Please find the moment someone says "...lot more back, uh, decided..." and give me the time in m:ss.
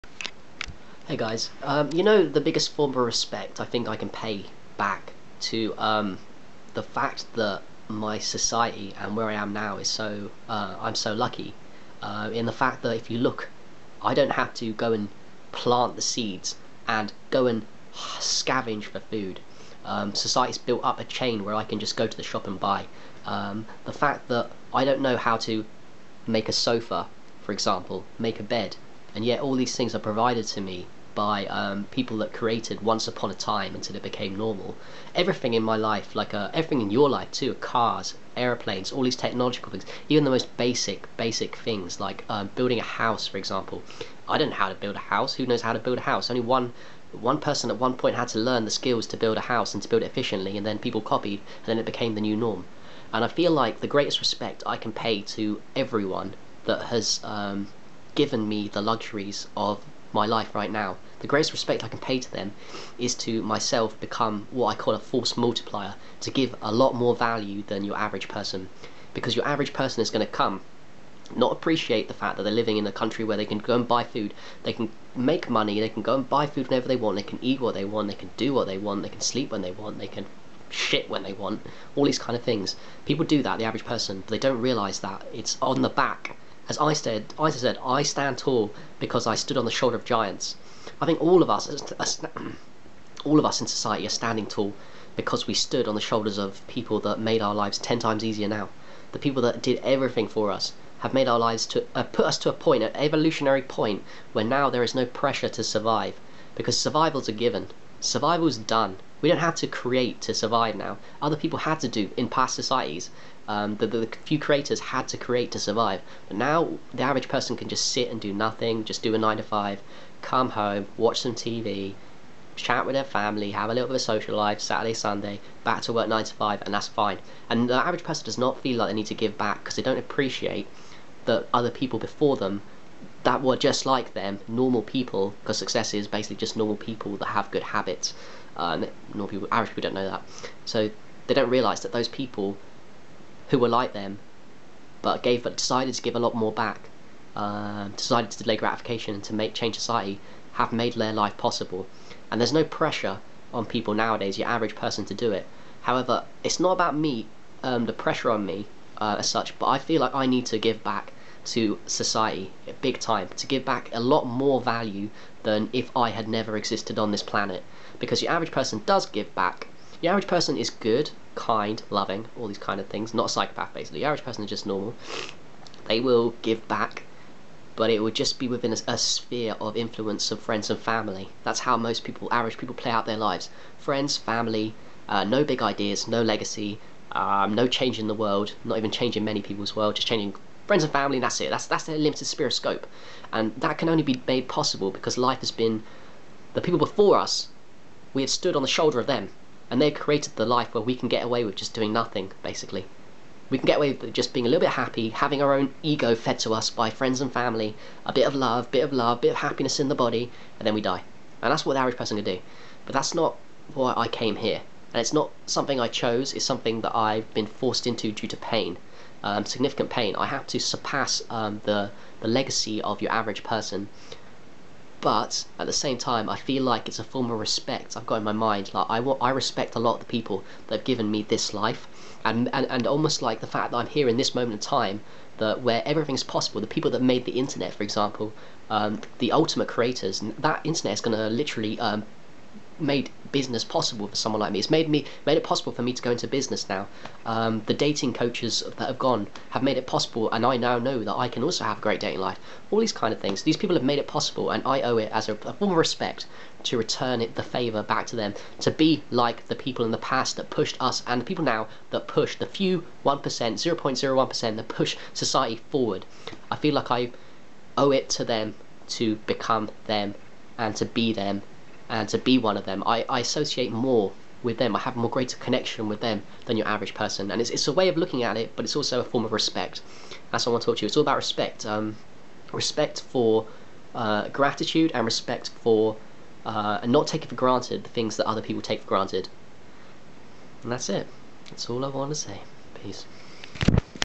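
2:26.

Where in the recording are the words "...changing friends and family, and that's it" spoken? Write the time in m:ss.
3:10.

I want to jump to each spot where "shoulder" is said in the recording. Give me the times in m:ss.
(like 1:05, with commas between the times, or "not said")
1:29, 1:35, 3:18.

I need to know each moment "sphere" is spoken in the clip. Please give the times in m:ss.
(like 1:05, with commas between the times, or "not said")
2:58, 3:12.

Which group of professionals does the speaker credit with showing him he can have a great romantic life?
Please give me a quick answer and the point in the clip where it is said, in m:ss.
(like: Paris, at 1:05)
dating coaches, at 4:07.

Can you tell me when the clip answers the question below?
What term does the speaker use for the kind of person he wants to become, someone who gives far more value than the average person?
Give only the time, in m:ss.
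1:04.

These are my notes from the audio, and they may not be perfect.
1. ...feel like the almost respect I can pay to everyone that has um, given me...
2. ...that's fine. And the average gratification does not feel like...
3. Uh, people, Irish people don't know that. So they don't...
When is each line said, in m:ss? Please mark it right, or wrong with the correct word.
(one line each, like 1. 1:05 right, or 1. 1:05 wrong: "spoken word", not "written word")
1. 0:53 wrong: "greatest", not "almost"
2. 2:06 wrong: "person", not "gratification"
3. 2:18 right.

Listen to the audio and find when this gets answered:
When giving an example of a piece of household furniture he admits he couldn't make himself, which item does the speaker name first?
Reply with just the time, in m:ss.
0:26.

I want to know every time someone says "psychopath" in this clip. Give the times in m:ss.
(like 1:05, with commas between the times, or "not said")
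2:53.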